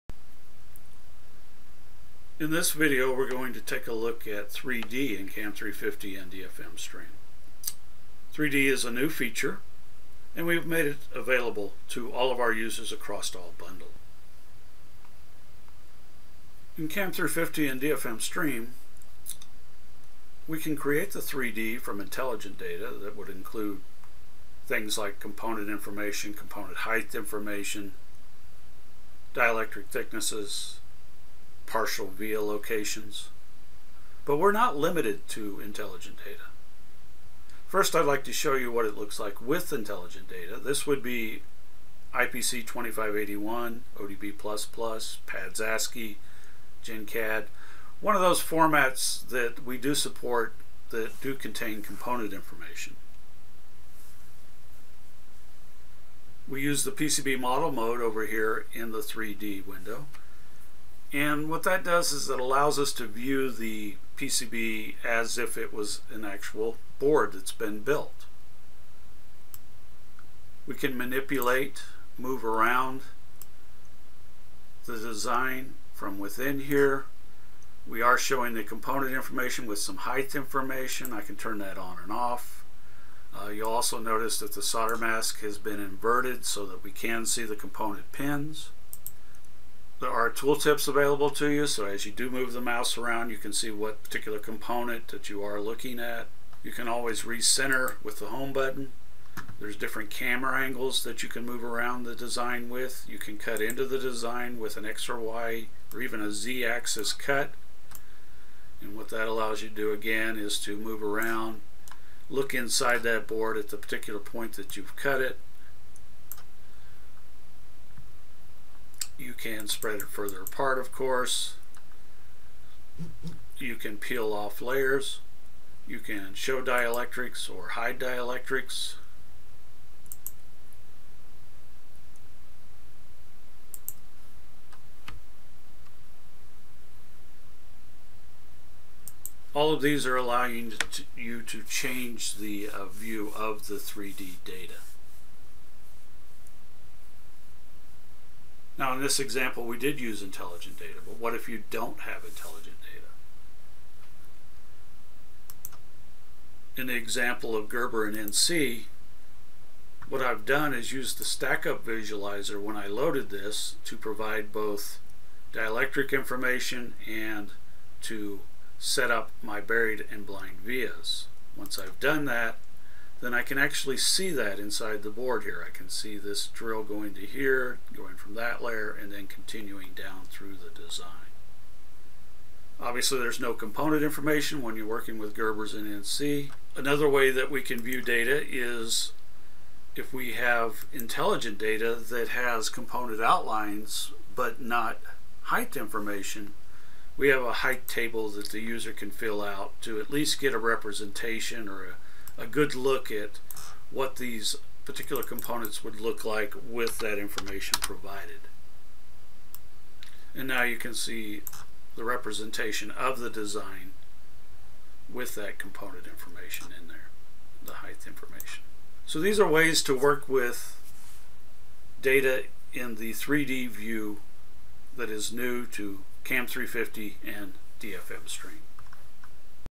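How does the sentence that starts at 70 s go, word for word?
We can manipulate, move around the design from within here.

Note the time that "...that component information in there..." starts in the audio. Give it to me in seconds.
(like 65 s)
215 s.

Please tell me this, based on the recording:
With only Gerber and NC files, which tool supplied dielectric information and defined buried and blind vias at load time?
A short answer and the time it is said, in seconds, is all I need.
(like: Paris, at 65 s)
Stack-up visualizer, at 161 s.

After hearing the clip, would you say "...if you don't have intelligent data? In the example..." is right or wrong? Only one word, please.
right.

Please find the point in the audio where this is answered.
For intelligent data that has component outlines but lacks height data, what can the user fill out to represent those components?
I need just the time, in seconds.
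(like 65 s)
197 s.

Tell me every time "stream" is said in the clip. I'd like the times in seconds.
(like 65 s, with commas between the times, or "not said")
6 s, 18 s, 228 s.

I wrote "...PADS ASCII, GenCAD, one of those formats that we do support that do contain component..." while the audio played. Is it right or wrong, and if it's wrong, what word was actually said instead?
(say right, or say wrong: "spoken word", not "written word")
right.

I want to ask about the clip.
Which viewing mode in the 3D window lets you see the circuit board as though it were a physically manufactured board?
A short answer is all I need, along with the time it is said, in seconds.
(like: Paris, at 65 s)
PCB model mode, at 56 s.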